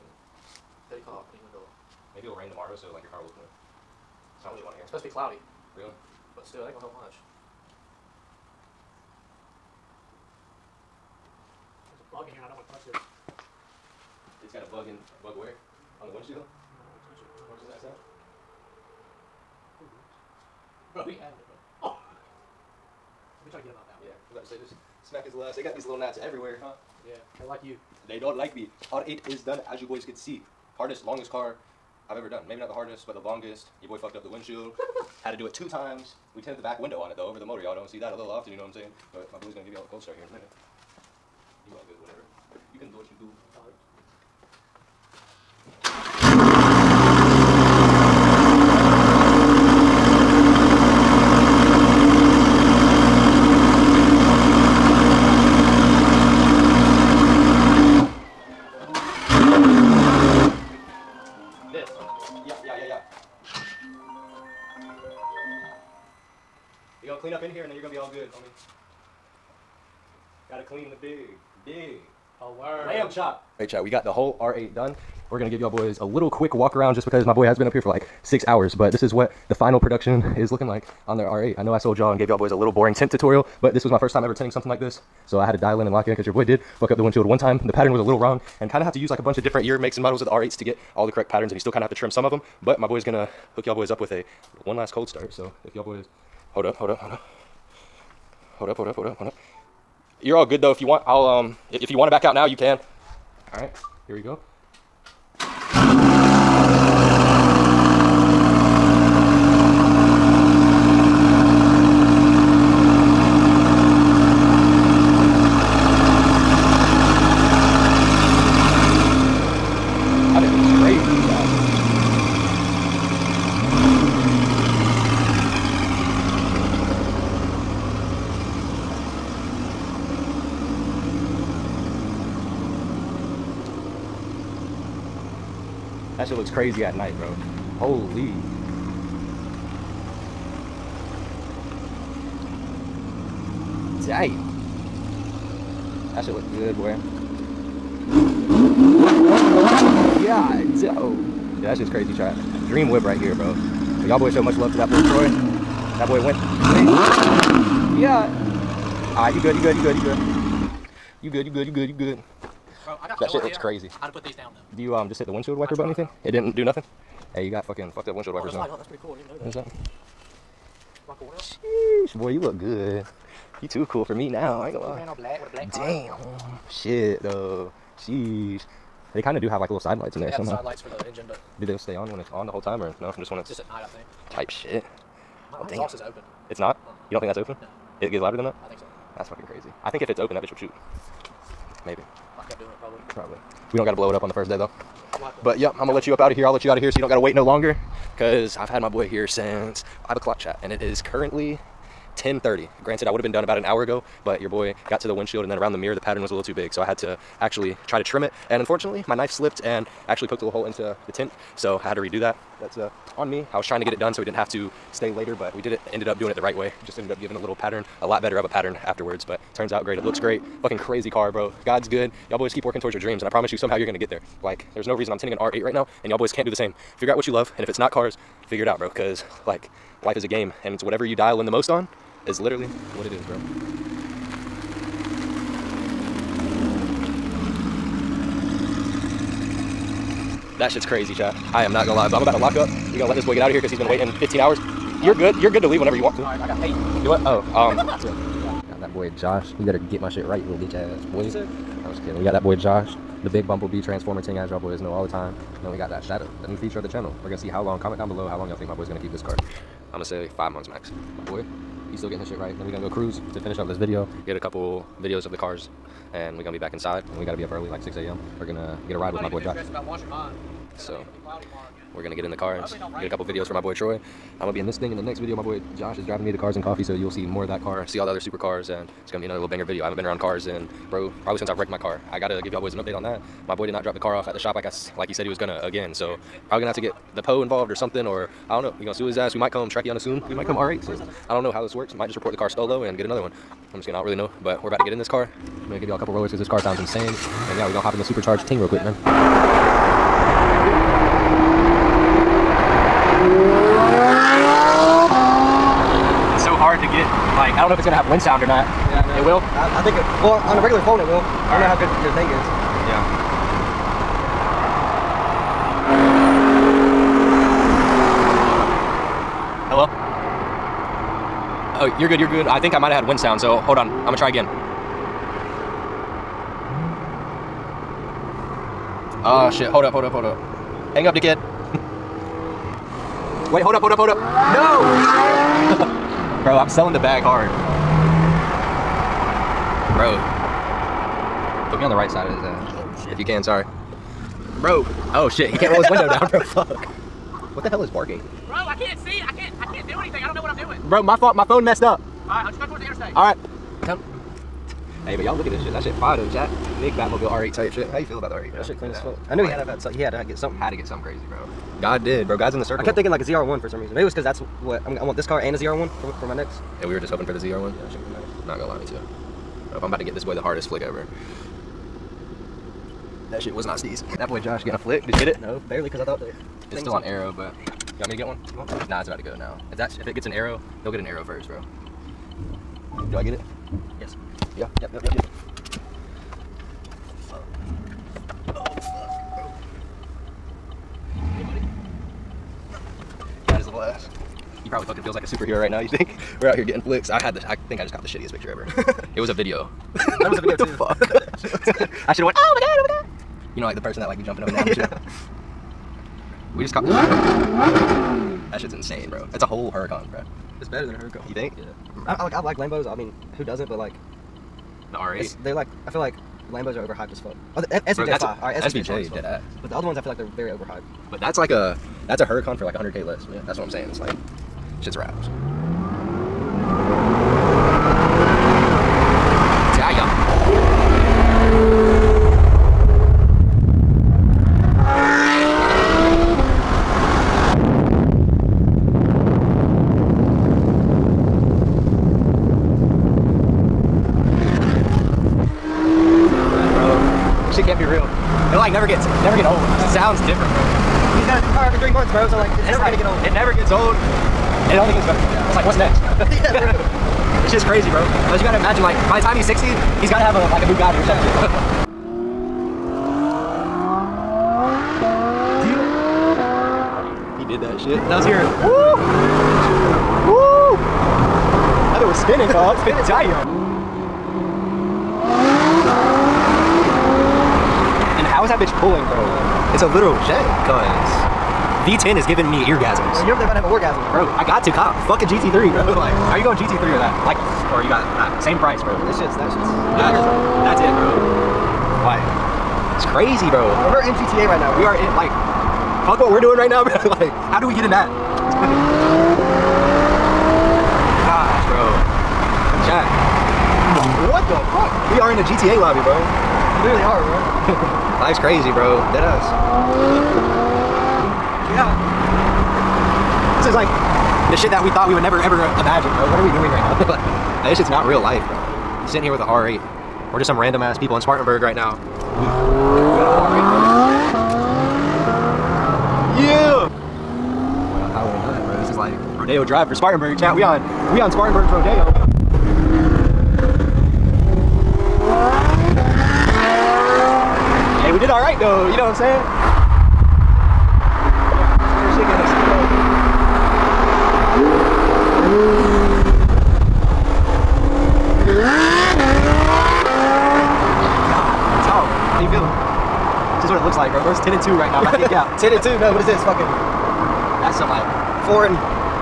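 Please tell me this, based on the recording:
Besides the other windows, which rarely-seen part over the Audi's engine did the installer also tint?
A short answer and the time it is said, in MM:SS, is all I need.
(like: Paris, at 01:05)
back window, at 00:36.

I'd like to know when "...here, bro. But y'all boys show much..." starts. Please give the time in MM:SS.
02:33.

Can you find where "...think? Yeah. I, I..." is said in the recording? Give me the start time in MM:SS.
06:51.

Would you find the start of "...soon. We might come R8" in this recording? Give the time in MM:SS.
04:49.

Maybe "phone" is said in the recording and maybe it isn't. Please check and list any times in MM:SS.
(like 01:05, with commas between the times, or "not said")
05:10, 05:51.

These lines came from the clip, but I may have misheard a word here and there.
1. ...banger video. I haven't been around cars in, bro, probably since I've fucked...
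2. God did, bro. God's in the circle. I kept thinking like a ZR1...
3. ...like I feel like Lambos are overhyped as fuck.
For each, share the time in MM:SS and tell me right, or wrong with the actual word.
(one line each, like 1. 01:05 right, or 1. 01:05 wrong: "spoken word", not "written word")
1. 04:39 wrong: "wrecked", not "fucked"
2. 06:01 right
3. 06:55 right.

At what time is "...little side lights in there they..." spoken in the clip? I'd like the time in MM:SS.
02:59.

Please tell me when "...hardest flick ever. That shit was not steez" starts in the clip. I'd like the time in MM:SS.
06:10.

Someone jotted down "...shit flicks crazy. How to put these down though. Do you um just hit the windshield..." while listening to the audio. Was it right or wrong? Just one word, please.
wrong.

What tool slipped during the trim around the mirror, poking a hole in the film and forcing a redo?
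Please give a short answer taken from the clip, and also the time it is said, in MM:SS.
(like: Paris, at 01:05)
knife, at 03:29.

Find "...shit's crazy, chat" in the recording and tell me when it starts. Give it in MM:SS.
04:00.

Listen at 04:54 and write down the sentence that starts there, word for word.
But we're about to get in this car.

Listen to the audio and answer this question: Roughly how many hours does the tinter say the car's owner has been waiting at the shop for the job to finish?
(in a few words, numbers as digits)
6.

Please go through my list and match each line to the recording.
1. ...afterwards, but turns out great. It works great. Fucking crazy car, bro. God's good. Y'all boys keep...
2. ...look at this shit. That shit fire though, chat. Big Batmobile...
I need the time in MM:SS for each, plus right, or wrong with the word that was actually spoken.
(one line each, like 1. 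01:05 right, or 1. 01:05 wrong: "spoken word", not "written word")
1. 03:38 wrong: "looks", not "works"
2. 05:55 right.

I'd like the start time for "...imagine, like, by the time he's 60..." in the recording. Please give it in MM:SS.
07:38.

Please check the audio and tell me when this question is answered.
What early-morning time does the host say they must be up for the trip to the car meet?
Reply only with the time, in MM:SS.
04:27.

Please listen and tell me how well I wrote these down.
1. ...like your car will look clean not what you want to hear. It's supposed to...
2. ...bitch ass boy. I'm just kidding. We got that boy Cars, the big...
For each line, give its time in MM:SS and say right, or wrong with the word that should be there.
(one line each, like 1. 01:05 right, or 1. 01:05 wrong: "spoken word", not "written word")
1. 00:02 right
2. 04:10 wrong: "Josh", not "Cars".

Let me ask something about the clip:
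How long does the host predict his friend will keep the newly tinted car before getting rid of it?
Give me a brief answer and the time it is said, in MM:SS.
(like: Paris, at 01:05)
5 months, at 04:20.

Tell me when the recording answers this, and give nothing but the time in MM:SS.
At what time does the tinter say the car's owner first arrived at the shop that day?
03:20.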